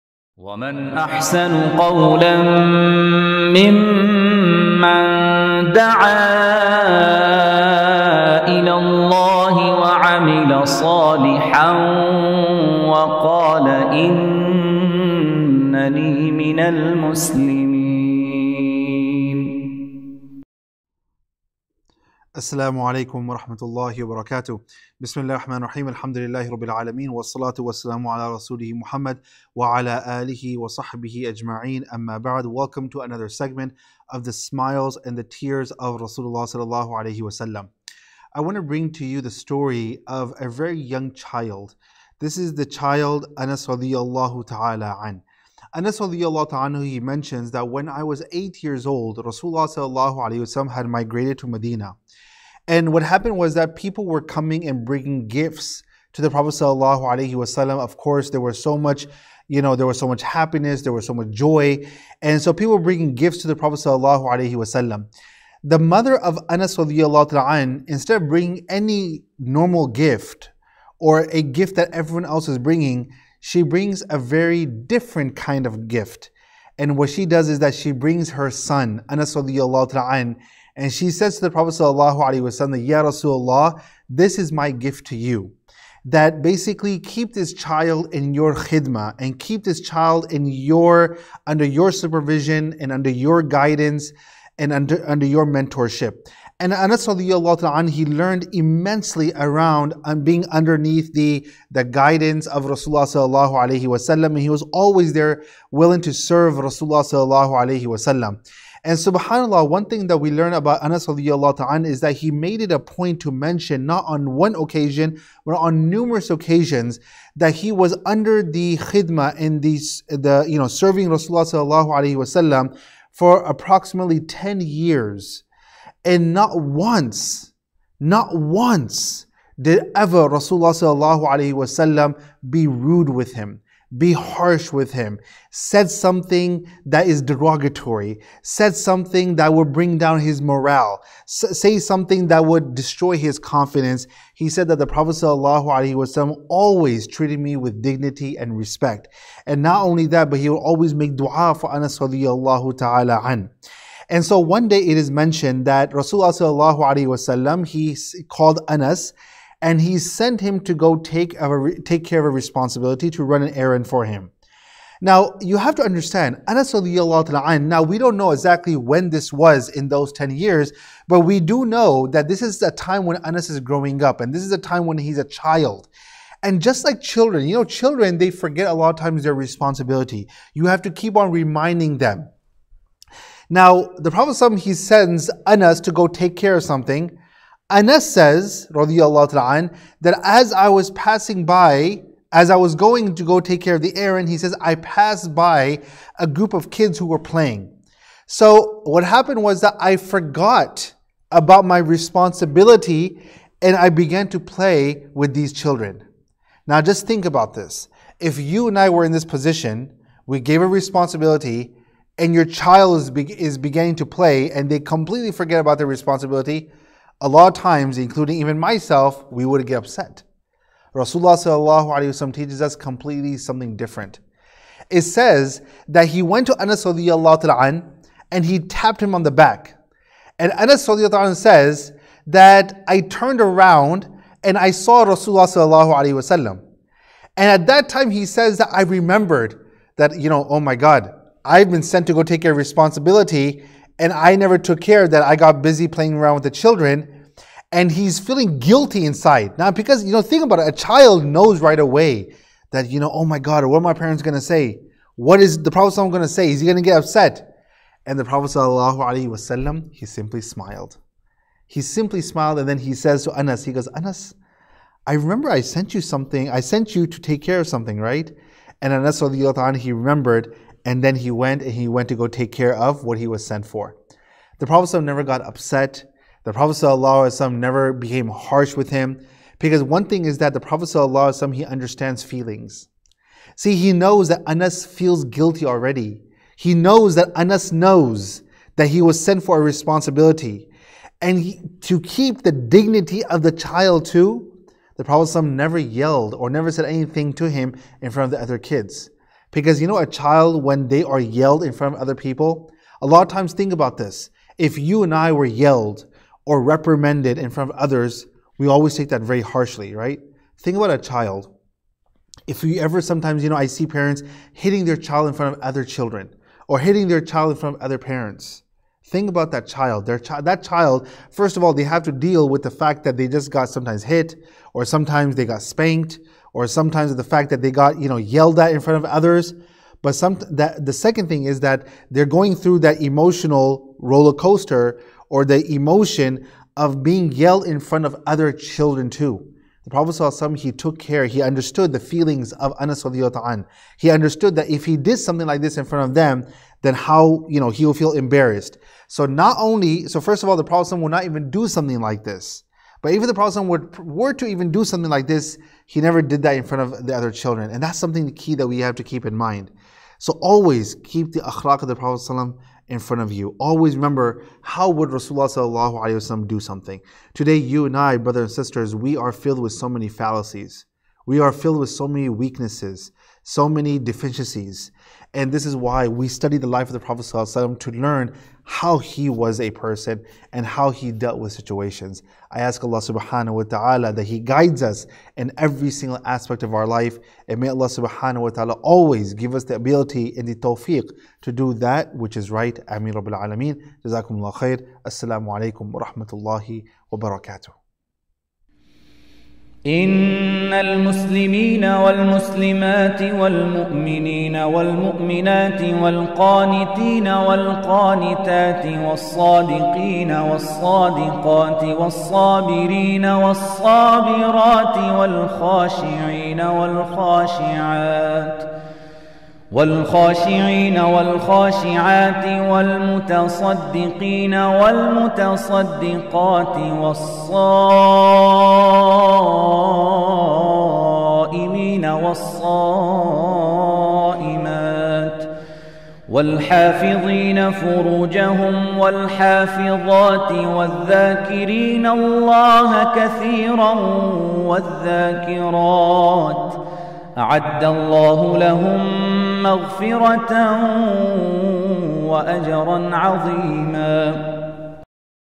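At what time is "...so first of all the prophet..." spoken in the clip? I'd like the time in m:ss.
5:50.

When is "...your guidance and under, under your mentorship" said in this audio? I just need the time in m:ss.
1:33.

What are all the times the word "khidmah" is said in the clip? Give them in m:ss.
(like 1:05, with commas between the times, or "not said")
1:28, 1:58.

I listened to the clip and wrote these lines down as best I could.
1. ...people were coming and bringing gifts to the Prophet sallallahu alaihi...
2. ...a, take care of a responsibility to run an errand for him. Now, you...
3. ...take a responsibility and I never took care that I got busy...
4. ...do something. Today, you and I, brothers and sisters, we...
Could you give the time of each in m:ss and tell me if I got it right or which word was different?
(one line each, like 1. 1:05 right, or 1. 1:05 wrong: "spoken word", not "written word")
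1. 0:53 right
2. 2:41 right
3. 4:02 right
4. 6:06 right.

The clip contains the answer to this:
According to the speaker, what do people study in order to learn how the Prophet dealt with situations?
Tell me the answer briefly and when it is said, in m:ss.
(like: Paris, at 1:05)
The life of the Prophet, at 6:16.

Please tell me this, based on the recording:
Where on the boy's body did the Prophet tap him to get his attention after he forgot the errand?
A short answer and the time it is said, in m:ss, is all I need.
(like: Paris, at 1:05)
On the back, at 3:49.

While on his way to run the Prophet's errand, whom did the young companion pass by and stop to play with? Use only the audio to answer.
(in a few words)
A group of kids.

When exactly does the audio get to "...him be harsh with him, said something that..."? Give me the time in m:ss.
2:13.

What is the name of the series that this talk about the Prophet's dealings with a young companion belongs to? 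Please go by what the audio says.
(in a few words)
The Smiles and the Tears of Rasulullah.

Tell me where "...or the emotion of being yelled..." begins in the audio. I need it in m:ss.
5:35.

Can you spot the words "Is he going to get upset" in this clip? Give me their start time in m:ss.
4:16.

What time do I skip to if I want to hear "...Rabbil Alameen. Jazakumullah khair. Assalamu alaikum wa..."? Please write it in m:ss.
6:33.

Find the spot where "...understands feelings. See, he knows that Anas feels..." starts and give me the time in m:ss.
4:41.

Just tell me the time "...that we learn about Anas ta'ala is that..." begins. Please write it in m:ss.
1:50.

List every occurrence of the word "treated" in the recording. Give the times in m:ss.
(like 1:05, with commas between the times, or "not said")
2:27.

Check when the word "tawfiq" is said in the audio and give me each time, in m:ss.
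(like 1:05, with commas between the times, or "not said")
6:30.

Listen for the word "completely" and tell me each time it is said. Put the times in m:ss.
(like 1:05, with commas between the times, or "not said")
3:34, 3:42.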